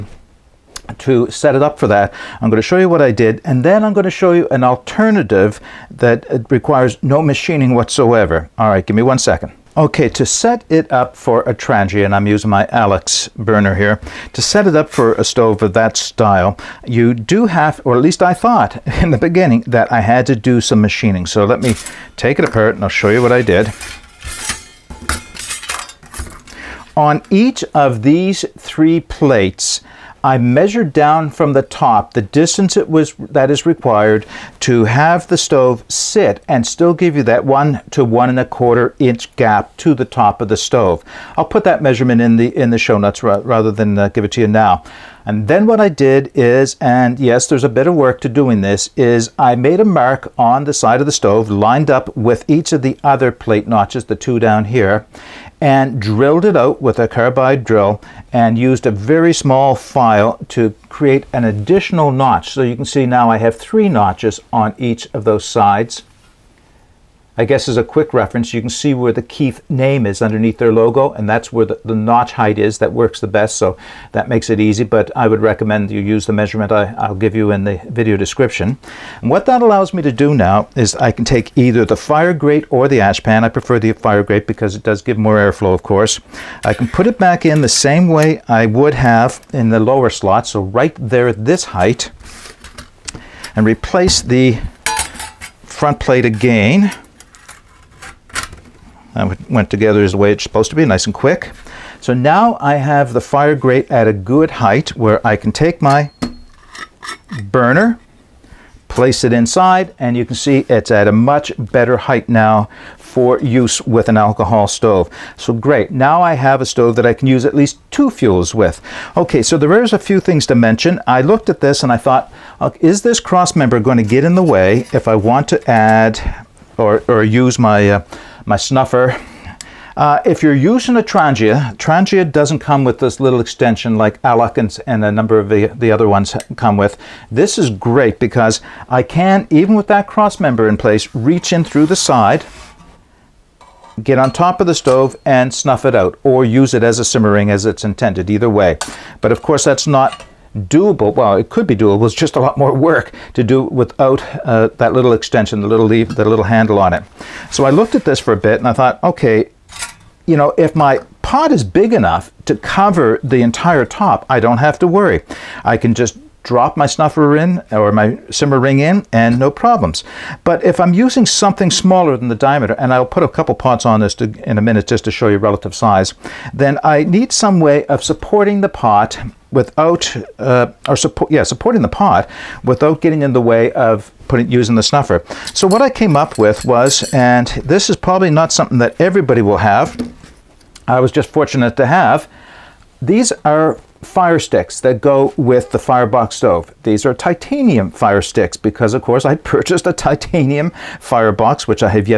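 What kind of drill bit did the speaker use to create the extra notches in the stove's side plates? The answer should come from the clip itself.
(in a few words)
Carbide drill.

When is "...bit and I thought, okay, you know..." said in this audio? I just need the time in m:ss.
2:38.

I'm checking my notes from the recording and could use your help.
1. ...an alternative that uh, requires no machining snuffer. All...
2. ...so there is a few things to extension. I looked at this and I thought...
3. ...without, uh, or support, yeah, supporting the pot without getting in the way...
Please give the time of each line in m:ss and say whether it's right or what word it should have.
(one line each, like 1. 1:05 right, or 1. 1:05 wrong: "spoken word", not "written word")
1. 0:04 wrong: "whatsoever", not "snuffer"
2. 1:59 wrong: "mention", not "extension"
3. 2:59 right.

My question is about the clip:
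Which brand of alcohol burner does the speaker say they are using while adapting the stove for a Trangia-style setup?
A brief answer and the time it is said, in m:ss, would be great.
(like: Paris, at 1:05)
Alocs, at 0:12.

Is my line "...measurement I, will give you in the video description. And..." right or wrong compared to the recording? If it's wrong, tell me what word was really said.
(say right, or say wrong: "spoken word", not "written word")
right.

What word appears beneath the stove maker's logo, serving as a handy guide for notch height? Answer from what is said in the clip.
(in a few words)
Keith.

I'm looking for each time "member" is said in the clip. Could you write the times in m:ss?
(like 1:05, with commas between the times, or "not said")
2:03, 2:20.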